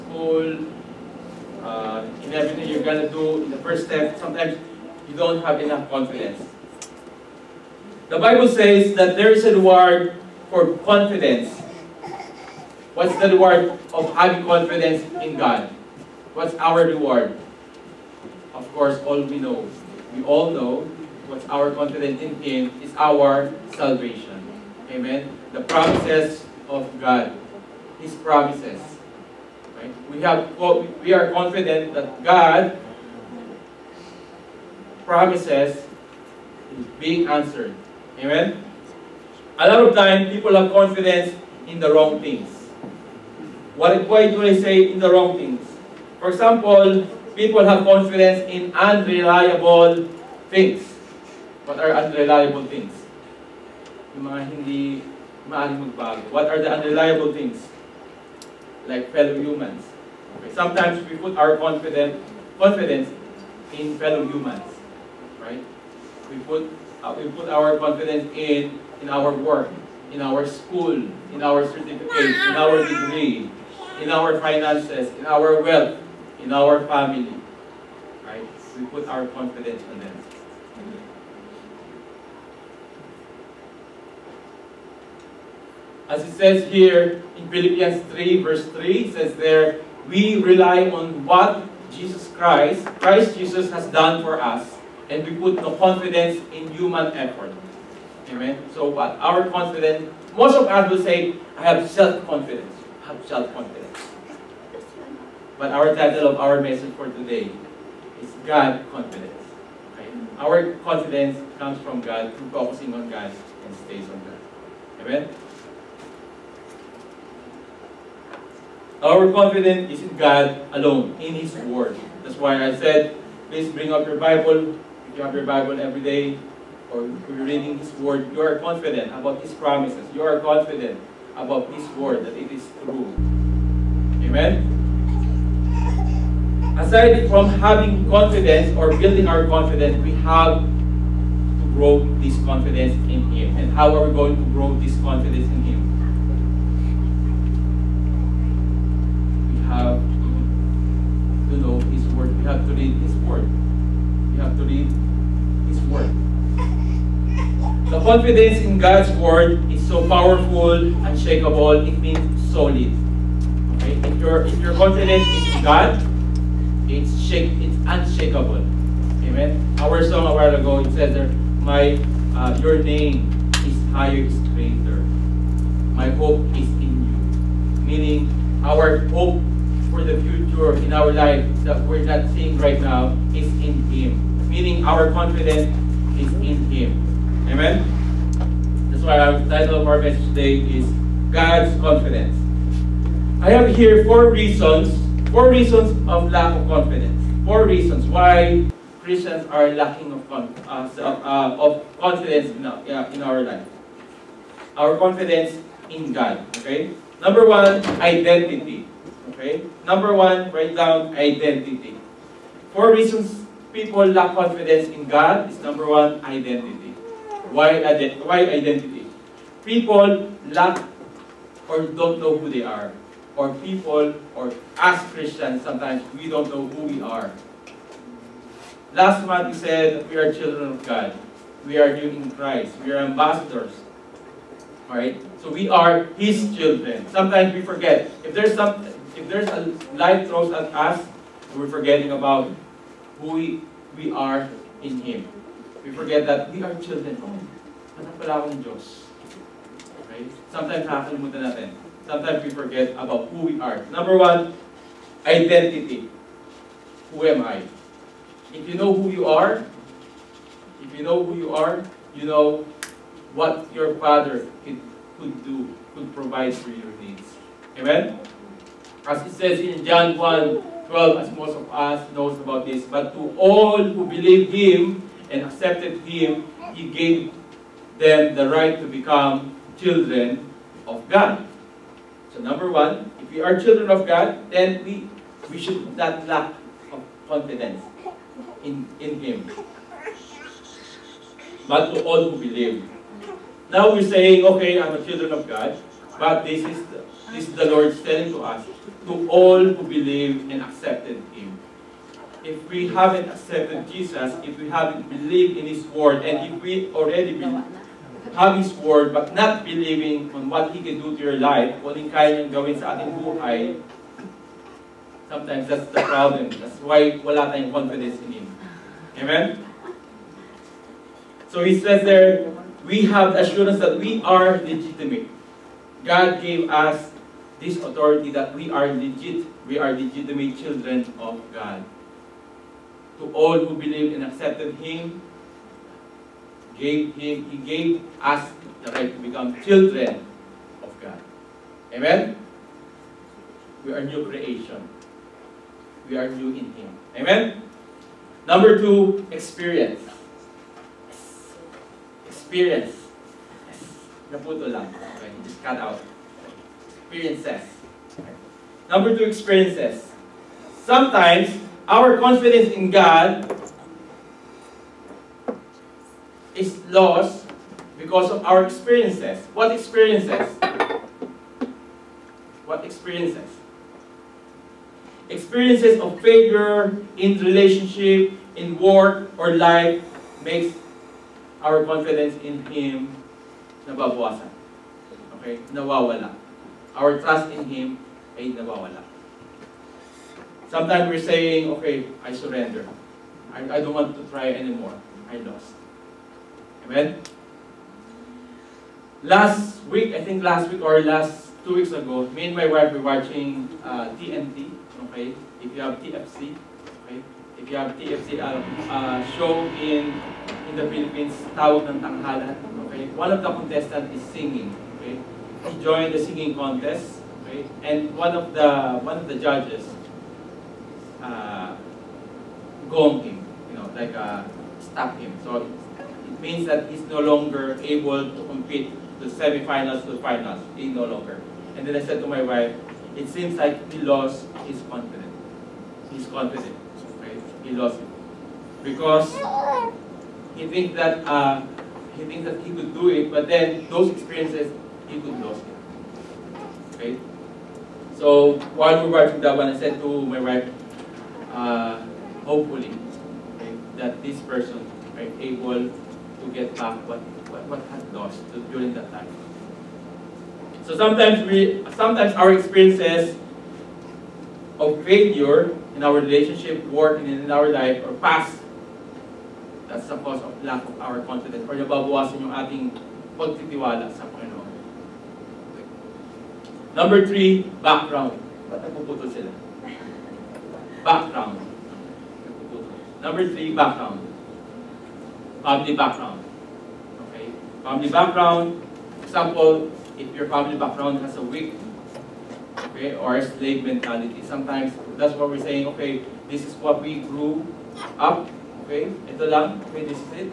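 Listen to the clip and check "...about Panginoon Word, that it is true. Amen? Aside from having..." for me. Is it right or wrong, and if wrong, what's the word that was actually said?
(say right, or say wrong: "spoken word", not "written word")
wrong: "His", not "Panginoon".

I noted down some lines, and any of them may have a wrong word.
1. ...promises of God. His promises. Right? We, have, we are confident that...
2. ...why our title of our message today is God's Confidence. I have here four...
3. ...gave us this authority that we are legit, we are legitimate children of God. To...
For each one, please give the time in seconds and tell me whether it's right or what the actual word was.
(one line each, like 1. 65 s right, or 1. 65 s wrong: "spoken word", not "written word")
1. 25 s right
2. 189 s right
3. 326 s right.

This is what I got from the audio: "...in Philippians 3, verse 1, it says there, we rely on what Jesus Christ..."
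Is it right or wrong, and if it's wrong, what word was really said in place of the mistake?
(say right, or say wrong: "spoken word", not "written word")
wrong: "3", not "1".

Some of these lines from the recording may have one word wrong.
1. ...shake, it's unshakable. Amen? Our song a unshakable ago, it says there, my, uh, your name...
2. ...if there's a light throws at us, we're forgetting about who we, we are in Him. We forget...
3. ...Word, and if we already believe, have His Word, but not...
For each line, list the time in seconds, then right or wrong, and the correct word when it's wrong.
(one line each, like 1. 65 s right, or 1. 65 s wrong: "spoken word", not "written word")
1. 167 s wrong: "while", not "unshakable"
2. 239 s right
3. 305 s right.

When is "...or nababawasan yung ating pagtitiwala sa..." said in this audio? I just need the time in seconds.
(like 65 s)
471 s.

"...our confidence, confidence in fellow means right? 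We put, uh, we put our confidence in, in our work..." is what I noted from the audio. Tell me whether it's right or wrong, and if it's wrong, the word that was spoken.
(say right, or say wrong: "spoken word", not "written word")
wrong: "humans", not "means".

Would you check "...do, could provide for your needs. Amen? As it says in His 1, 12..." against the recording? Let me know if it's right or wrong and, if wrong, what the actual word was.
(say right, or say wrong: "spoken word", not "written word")
wrong: "John", not "His".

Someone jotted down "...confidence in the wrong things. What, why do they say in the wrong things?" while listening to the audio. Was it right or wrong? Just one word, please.
right.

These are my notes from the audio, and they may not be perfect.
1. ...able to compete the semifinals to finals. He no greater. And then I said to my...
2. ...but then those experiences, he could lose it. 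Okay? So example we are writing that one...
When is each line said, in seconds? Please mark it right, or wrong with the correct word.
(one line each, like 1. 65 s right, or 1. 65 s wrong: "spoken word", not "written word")
1. 427 s wrong: "longer", not "greater"
2. 443 s wrong: "while", not "example".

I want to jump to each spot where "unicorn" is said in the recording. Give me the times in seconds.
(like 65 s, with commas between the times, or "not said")
not said.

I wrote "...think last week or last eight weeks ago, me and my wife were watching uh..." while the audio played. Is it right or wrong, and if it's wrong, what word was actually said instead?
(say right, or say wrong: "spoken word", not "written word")
wrong: "two", not "eight".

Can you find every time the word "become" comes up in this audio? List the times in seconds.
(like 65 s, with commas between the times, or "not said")
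278 s, 339 s.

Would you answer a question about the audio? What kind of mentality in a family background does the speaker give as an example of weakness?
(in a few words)
Slave mentality.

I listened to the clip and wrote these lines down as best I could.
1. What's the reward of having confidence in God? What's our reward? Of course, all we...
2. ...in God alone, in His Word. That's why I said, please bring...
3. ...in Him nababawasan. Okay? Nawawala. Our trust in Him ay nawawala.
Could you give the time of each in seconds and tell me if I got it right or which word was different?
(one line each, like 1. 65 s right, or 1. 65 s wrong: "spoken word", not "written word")
1. 12 s right
2. 120 s right
3. 382 s right.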